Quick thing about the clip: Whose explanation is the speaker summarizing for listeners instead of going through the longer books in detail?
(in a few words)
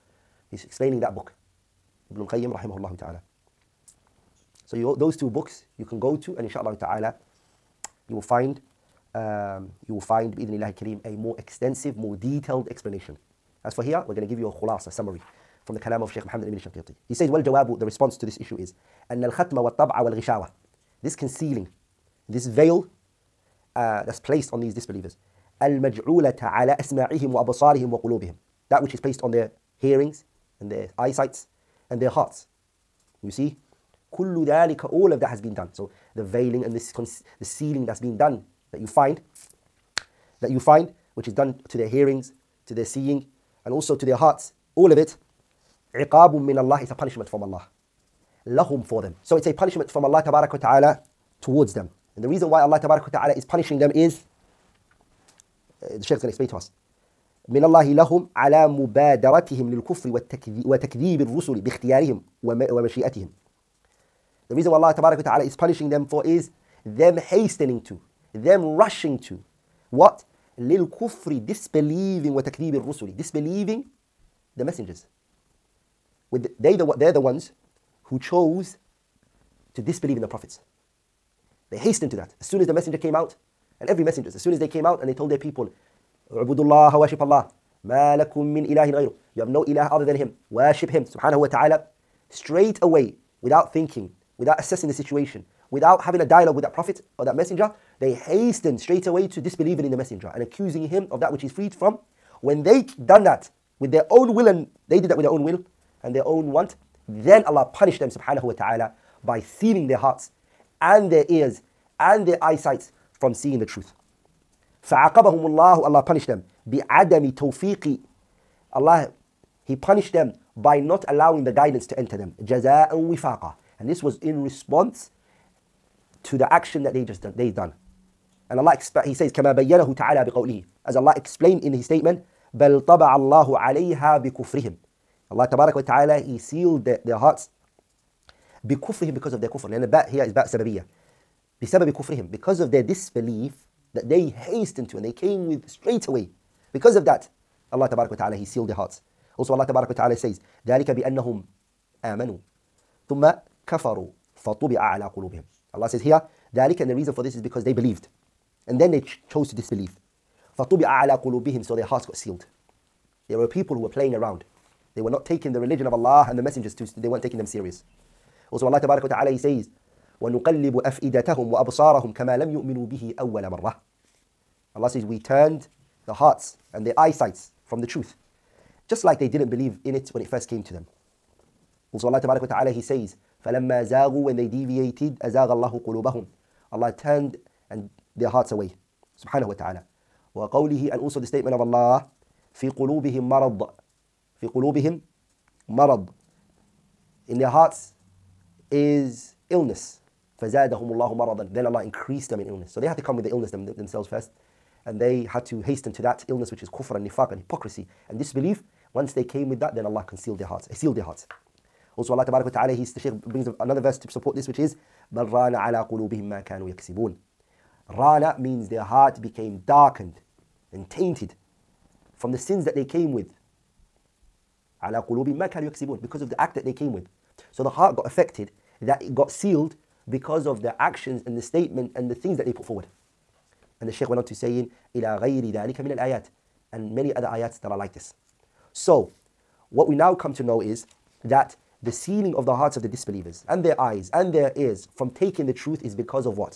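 Sheikh Muhammad ibn Shanqiti.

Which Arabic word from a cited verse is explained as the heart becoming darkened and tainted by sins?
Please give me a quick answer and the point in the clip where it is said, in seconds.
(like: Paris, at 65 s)
Rana, at 217 s.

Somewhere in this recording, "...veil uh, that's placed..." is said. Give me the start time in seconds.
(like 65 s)
22 s.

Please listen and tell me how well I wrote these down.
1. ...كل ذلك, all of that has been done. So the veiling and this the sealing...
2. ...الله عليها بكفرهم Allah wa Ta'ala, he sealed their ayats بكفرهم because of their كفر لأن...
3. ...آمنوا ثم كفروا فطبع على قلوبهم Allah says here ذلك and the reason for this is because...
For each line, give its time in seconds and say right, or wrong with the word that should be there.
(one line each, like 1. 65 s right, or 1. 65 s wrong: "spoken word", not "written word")
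1. 34 s right
2. 133 s wrong: "hearts", not "ayats"
3. 152 s right.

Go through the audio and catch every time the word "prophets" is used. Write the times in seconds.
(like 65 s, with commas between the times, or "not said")
80 s, 96 s.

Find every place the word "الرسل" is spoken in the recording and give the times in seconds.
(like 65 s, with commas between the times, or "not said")
61 s, 72 s.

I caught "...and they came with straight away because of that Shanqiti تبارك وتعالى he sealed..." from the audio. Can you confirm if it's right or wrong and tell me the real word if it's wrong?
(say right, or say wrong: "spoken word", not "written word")
wrong: "Allah", not "Shanqiti".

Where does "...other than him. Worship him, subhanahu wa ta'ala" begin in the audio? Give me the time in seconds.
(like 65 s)
89 s.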